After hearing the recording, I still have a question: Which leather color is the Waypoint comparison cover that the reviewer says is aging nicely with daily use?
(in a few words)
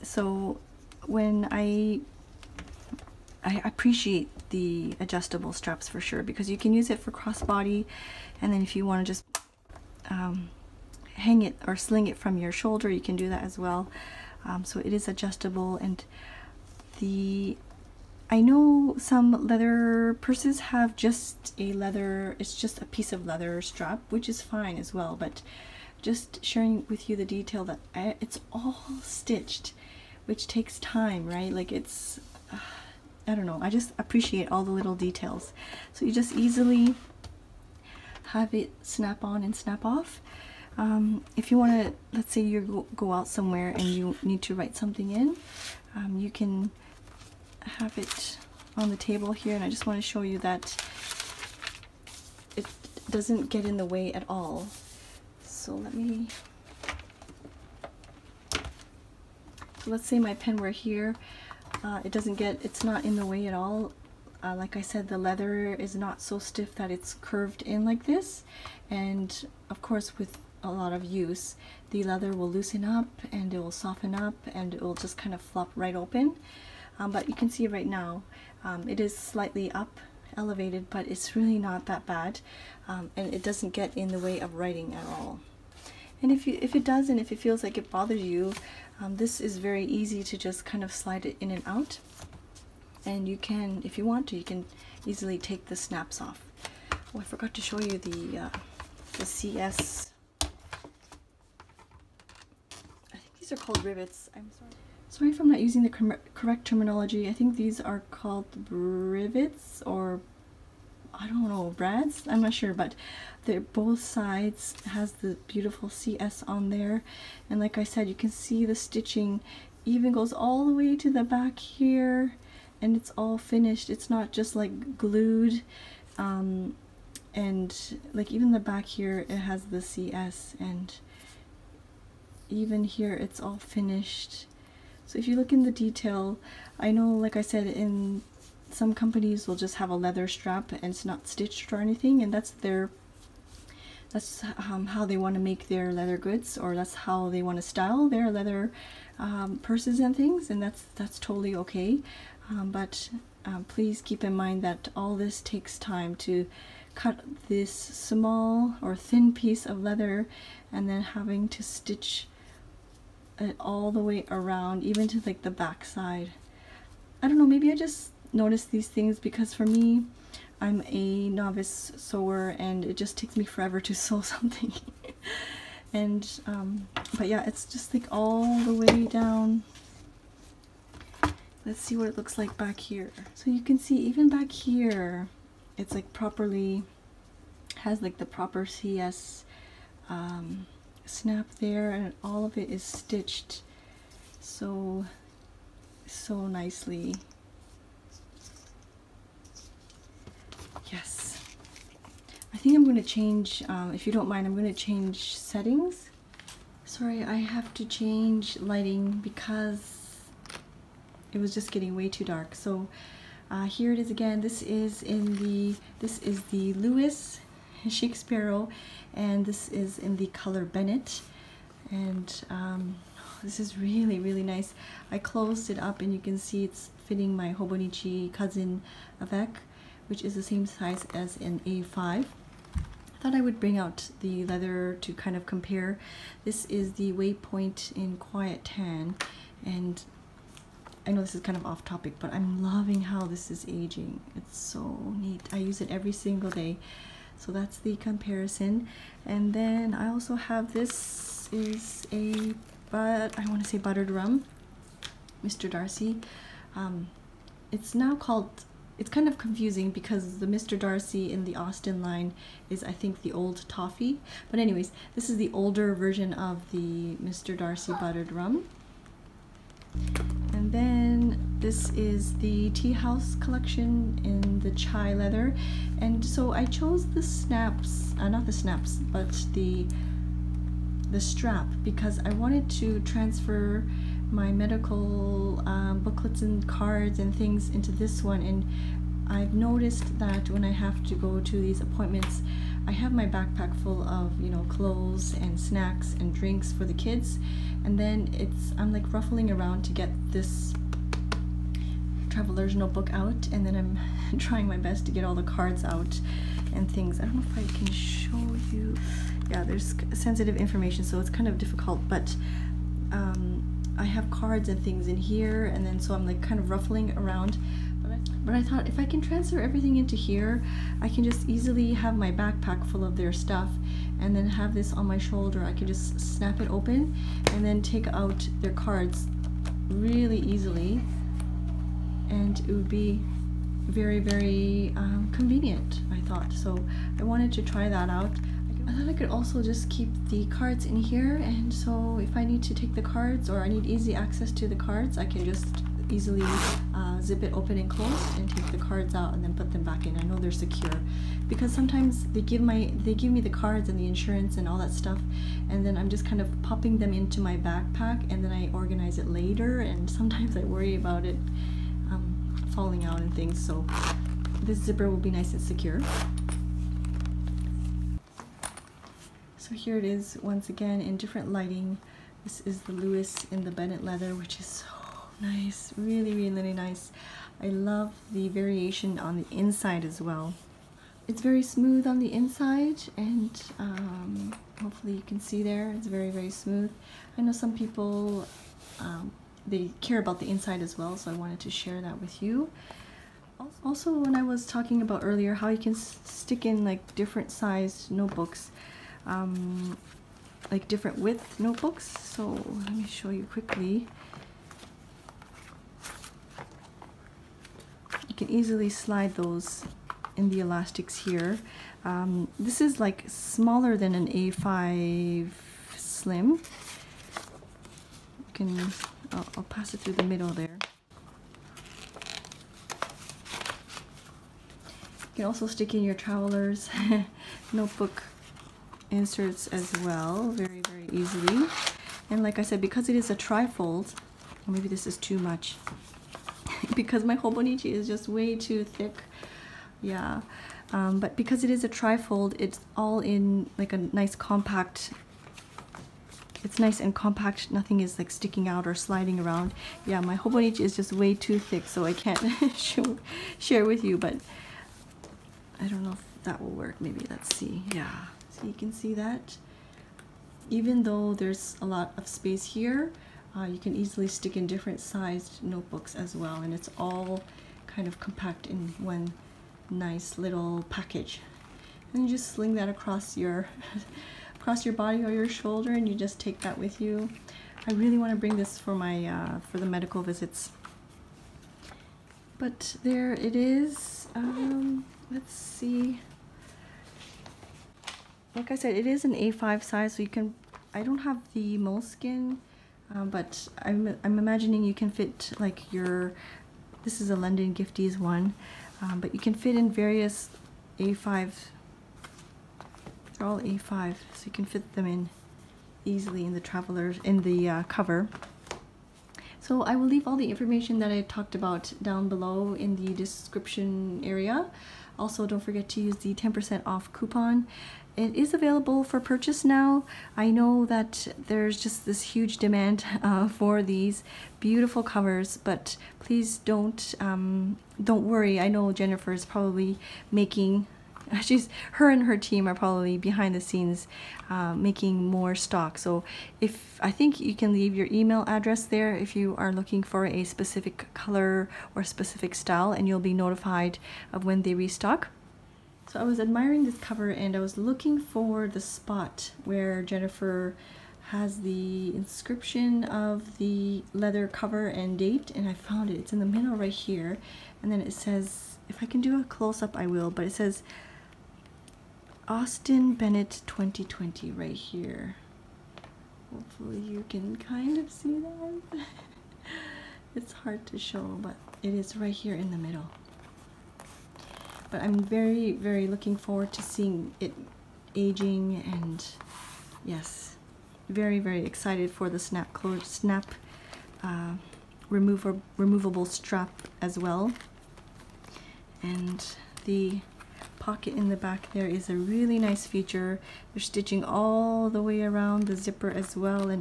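Quiet tan.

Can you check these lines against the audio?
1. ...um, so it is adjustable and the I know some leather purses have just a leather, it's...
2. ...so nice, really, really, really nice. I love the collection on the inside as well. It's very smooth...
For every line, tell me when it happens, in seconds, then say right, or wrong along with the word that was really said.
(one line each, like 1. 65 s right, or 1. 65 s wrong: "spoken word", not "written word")
1. 14 s right
2. 374 s wrong: "variation", not "collection".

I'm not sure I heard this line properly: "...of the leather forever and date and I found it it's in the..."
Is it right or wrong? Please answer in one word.
wrong.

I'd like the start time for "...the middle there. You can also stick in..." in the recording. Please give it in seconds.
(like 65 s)
420 s.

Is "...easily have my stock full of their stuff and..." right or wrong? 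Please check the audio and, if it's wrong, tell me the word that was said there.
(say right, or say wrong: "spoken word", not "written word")
wrong: "backpack", not "stock".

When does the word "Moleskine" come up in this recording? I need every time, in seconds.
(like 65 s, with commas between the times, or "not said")
491 s.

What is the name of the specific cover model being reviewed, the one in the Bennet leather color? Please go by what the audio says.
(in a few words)
Sparrow.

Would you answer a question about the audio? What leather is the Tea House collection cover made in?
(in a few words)
Chai.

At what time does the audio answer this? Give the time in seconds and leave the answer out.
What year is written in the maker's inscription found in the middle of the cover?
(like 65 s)
563 s.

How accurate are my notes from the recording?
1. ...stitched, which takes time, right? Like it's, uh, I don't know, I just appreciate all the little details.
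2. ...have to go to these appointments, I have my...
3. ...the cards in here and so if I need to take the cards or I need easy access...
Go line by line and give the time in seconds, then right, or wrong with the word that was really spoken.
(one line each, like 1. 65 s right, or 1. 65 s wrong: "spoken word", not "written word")
1. 29 s right
2. 290 s right
3. 340 s right.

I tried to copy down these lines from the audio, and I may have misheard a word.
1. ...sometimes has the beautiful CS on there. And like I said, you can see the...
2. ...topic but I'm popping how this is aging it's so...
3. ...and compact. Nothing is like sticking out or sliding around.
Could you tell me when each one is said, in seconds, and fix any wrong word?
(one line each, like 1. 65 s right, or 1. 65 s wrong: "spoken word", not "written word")
1. 114 s wrong: "sides", not "sometimes"
2. 241 s wrong: "loving", not "popping"
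3. 446 s right.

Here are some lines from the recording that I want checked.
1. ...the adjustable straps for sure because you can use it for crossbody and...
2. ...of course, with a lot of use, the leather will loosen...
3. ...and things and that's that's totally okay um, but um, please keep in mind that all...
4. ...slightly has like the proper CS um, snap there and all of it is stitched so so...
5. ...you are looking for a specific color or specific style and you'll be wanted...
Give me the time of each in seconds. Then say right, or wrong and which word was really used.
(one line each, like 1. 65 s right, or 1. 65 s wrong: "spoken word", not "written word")
1. 4 s right
2. 69 s right
3. 149 s right
4. 186 s wrong: "properly", not "slightly"
5. 539 s wrong: "notified", not "wanted".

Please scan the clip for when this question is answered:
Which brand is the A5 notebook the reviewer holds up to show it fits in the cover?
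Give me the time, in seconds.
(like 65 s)
497 s.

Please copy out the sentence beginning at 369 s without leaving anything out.
So here it is once again in different lighting.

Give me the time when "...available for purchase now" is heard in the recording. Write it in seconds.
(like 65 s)
518 s.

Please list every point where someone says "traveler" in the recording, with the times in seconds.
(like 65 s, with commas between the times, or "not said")
302 s, 426 s, 506 s.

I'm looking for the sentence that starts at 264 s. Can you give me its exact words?
But anyways, this is the older version of the Mr.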